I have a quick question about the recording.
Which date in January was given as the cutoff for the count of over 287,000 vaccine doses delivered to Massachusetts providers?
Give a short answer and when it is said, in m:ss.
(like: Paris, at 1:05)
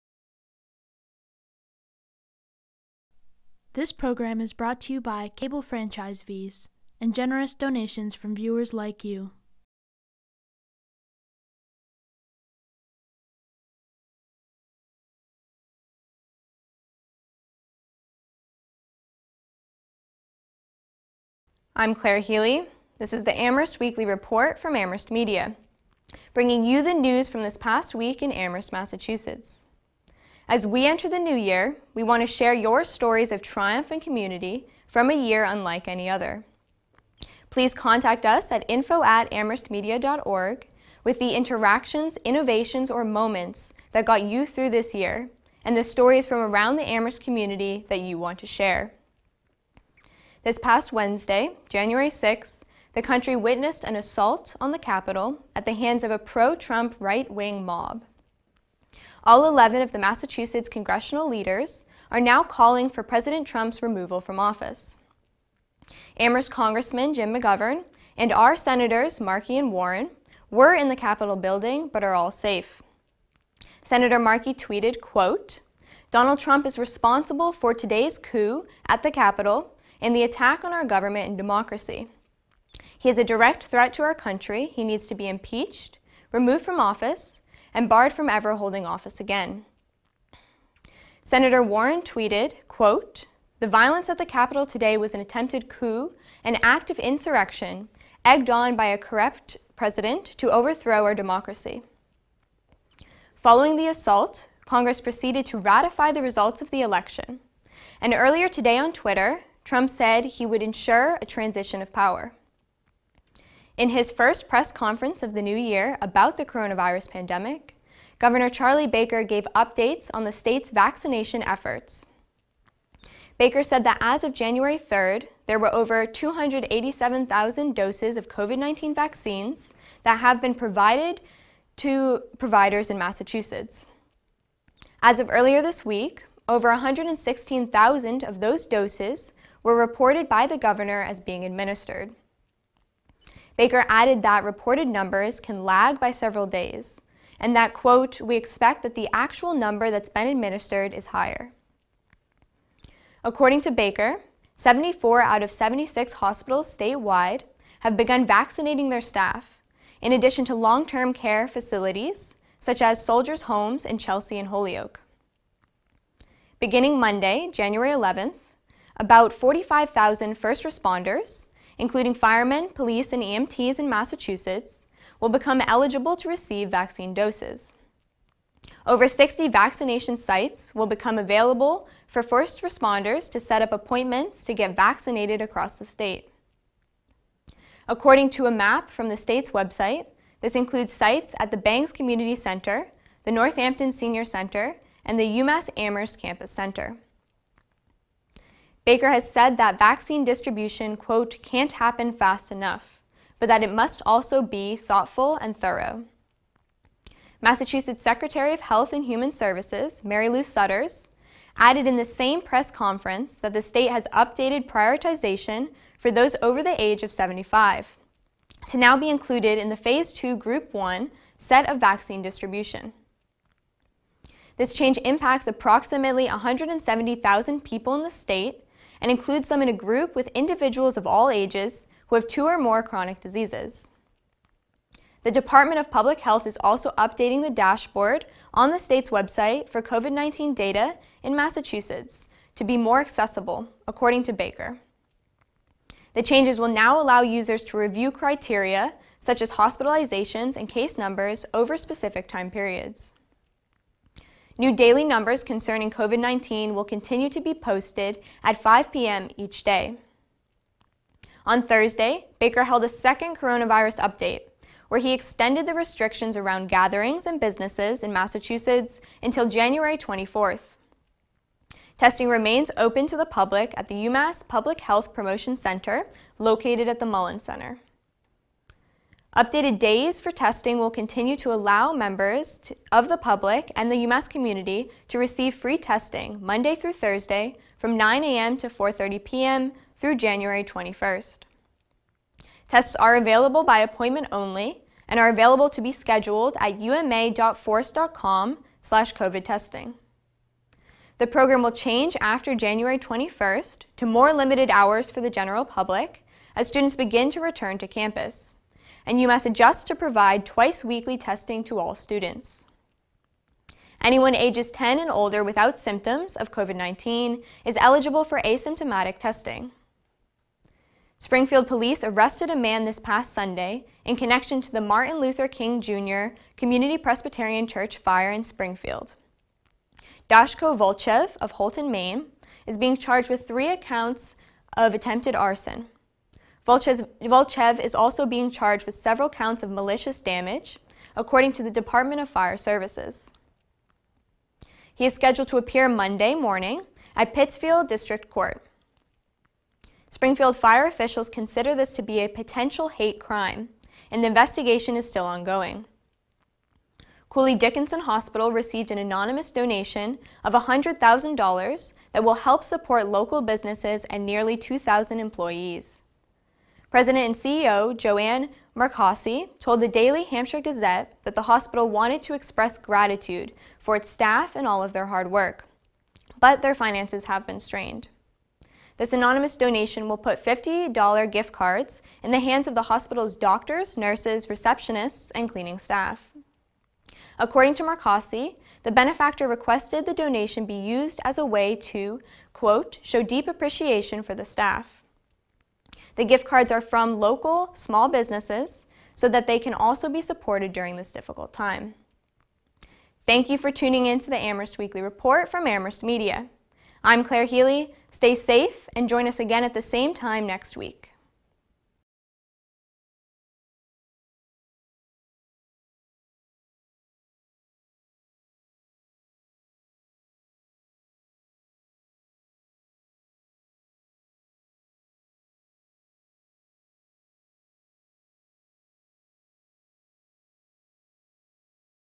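January 3rd, at 2:04.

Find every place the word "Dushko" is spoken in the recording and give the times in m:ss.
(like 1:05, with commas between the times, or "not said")
5:30.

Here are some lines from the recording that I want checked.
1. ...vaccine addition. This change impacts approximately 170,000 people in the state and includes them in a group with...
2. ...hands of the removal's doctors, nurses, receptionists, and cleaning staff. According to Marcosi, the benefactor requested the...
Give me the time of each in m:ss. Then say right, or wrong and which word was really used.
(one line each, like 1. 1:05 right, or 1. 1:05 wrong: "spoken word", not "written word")
1. 3:41 wrong: "distribution", not "addition"
2. 6:22 wrong: "hospital", not "removal".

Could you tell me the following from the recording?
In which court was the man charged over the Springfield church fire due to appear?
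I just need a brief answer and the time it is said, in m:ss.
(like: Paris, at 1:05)
Pittsfield District Court, at 5:47.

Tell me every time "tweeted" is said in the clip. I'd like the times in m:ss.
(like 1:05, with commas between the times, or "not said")
1:14, 1:32.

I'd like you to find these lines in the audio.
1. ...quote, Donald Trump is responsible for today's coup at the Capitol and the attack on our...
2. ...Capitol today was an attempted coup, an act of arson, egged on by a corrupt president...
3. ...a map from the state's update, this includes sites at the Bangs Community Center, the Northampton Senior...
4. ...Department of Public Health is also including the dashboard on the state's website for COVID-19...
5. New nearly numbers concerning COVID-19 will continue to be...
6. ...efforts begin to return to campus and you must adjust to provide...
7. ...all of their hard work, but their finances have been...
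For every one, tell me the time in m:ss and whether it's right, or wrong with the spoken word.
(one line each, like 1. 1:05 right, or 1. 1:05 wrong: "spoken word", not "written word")
1. 1:15 right
2. 1:34 wrong: "insurrection", not "arson"
3. 3:08 wrong: "website", not "update"
4. 3:55 wrong: "updating", not "including"
5. 4:14 wrong: "daily", not "nearly"
6. 5:06 wrong: "students", not "efforts"
7. 6:14 right.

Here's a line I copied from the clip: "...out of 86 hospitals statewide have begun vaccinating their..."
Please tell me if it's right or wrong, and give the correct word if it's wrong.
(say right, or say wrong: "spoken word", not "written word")
wrong: "76", not "86".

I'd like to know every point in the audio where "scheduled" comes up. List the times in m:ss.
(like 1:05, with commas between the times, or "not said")
4:55, 5:45.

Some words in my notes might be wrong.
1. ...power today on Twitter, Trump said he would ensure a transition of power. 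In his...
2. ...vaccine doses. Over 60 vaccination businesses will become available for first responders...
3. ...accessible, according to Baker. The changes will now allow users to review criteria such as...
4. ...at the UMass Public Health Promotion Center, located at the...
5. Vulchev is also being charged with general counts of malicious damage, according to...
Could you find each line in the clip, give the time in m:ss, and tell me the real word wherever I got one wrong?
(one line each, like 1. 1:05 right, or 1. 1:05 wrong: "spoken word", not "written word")
1. 1:48 wrong: "earlier", not "power"
2. 2:56 wrong: "sites", not "businesses"
3. 4:03 right
4. 4:33 right
5. 5:36 wrong: "several", not "general".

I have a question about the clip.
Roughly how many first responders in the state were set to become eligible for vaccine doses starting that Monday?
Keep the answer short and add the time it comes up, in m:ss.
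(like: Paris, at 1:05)
45,000, at 2:49.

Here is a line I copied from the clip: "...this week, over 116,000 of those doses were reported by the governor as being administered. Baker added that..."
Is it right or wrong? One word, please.
right.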